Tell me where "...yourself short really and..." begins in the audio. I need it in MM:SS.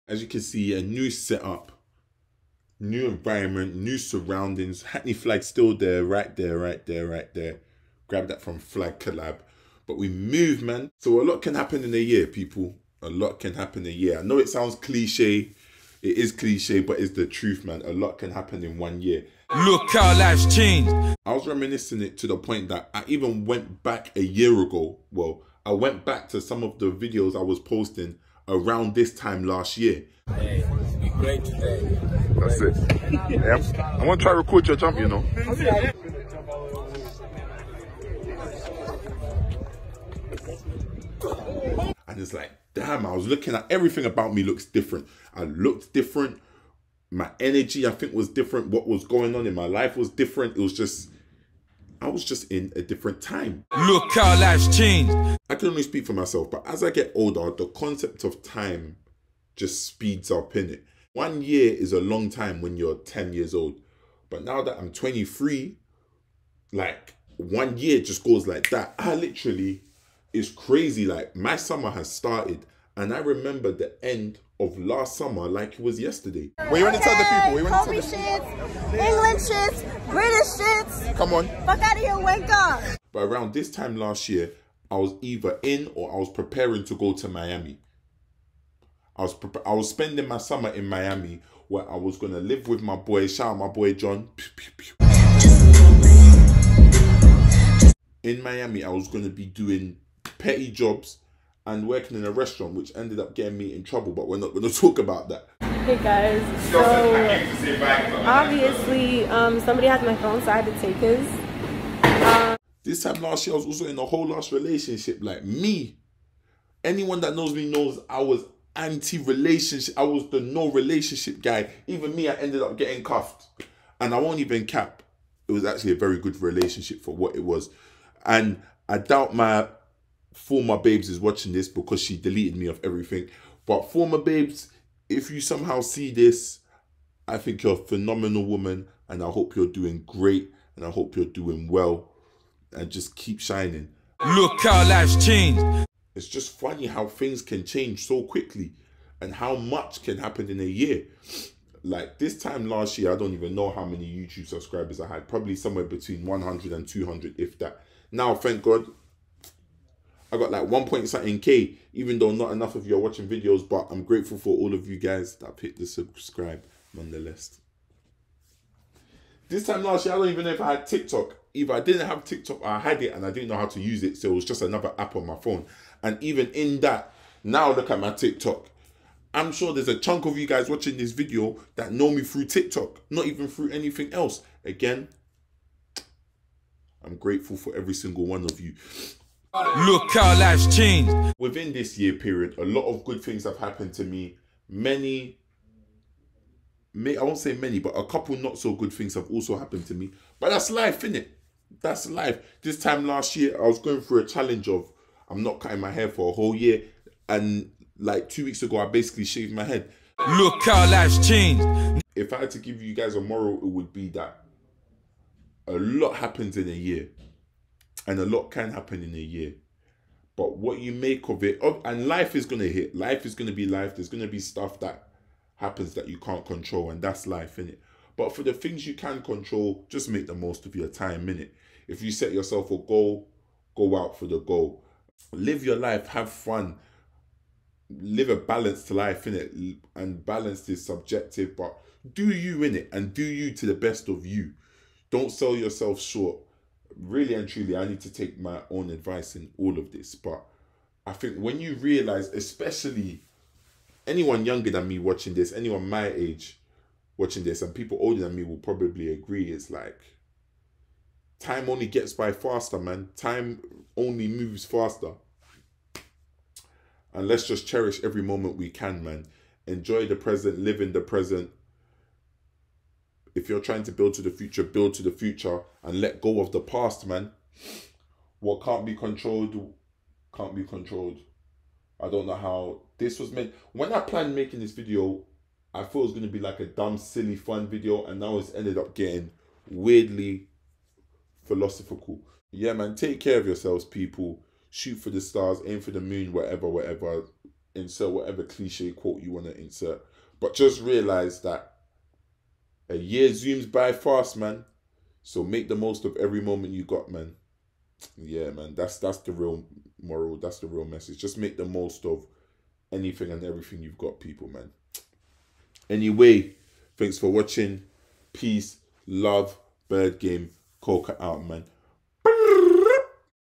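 04:05.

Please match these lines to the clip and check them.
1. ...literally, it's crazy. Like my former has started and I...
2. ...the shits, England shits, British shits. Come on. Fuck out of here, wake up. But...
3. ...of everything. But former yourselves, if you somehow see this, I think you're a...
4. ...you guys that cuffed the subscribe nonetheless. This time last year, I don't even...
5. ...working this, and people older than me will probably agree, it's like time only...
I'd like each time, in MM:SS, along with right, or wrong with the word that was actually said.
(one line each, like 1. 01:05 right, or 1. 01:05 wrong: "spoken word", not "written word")
1. 01:09 wrong: "summer", not "former"
2. 01:18 right
3. 02:12 wrong: "babes", not "yourselves"
4. 02:44 wrong: "picked", not "cuffed"
5. 04:17 wrong: "watching", not "working".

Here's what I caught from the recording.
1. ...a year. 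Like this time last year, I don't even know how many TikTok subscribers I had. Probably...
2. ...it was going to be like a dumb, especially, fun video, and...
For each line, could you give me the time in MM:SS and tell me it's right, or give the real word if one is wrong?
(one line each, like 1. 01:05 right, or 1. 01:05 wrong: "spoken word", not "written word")
1. 02:30 wrong: "YouTube", not "TikTok"
2. 04:46 wrong: "silly", not "especially".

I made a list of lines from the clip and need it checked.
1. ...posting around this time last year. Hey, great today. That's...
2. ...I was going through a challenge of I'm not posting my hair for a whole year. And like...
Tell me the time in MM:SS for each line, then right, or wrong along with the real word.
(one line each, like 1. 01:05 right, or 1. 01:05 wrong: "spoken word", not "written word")
1. 00:27 right
2. 03:23 wrong: "cutting", not "posting".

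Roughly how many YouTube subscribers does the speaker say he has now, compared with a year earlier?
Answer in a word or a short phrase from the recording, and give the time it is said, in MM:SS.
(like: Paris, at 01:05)
1 point something K, at 02:40.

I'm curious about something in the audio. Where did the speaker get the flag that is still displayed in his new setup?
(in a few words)
Flag Collab.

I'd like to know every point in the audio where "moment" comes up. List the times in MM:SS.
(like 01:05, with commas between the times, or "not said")
04:28, 05:06.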